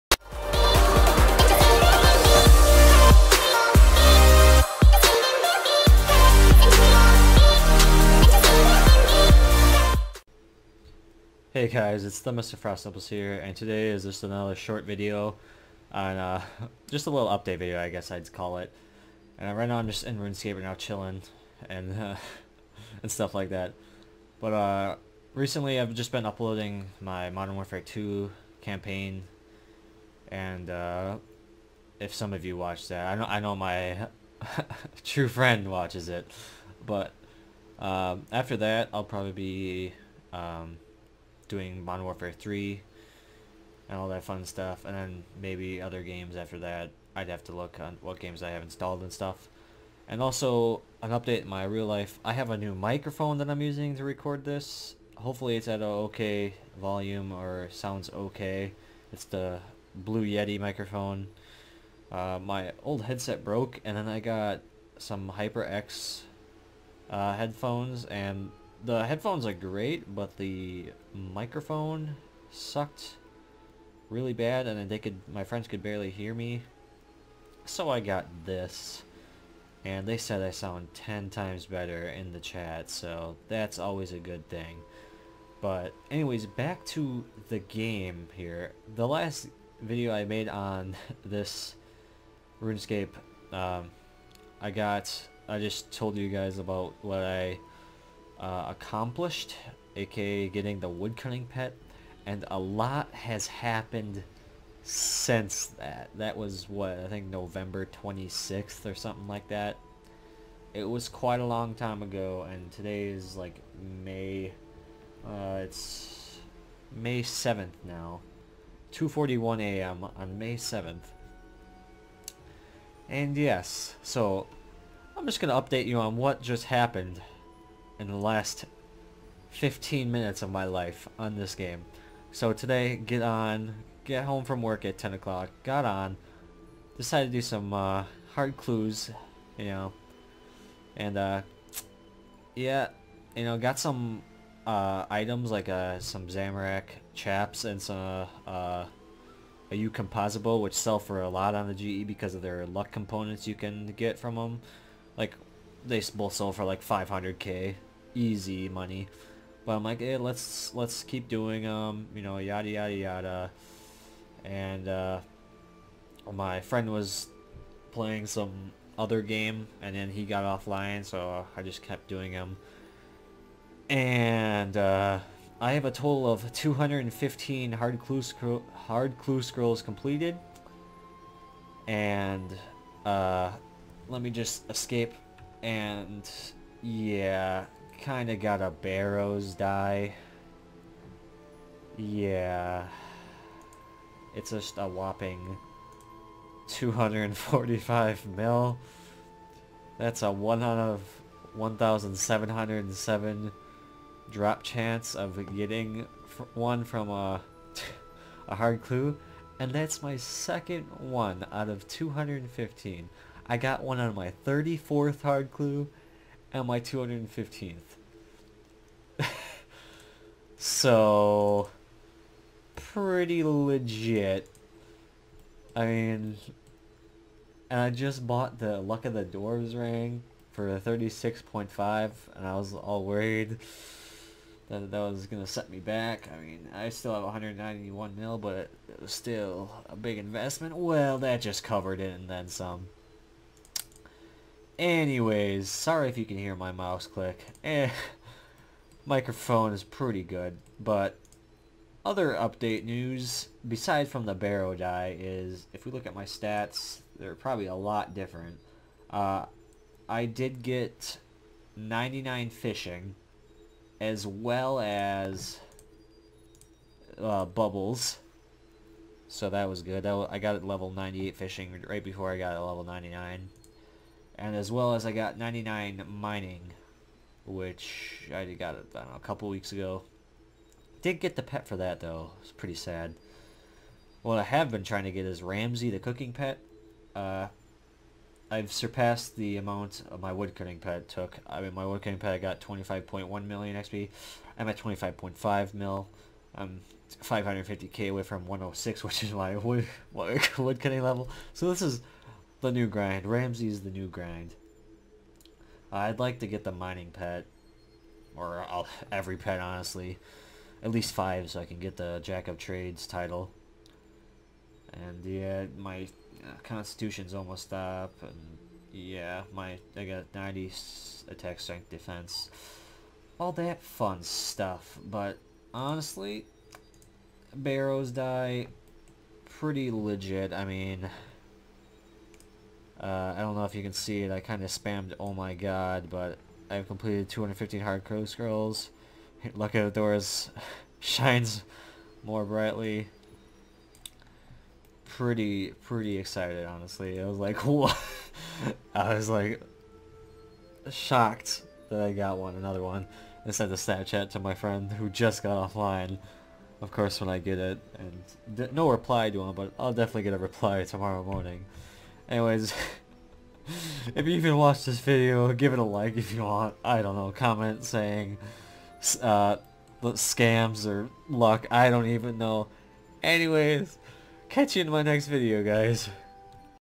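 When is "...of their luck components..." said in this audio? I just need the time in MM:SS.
02:32.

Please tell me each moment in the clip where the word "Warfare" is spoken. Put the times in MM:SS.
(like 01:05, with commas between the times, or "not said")
00:27, 00:42.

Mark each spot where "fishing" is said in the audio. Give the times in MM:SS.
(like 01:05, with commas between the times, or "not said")
04:22, 04:31.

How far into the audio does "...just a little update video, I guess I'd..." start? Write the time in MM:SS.
00:16.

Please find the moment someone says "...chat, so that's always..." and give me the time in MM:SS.
01:22.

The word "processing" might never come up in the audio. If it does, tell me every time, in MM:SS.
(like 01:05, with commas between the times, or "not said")
not said.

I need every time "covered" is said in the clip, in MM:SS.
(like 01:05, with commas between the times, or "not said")
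04:01.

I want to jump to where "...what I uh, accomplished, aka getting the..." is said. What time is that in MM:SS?
01:37.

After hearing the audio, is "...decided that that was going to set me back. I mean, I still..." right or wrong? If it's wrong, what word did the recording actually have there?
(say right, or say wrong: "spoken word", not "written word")
wrong: "worried", not "decided".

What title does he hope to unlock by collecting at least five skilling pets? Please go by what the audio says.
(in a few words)
Jack of Trades.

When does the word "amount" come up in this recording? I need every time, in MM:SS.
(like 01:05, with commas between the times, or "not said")
04:49.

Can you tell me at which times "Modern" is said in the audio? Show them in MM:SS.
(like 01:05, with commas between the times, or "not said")
00:27, 00:41.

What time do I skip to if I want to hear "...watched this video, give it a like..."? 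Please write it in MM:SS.
06:04.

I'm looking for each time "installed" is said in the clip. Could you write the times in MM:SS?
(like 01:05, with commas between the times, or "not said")
00:48.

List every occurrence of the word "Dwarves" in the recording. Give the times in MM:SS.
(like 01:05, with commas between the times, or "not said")
03:49, 05:39.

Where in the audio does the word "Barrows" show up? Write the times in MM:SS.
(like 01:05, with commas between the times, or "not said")
03:08, 04:14, 05:27.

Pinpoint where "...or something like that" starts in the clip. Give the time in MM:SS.
01:48.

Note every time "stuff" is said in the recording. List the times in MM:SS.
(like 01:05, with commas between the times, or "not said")
00:23, 00:44, 00:49, 05:24.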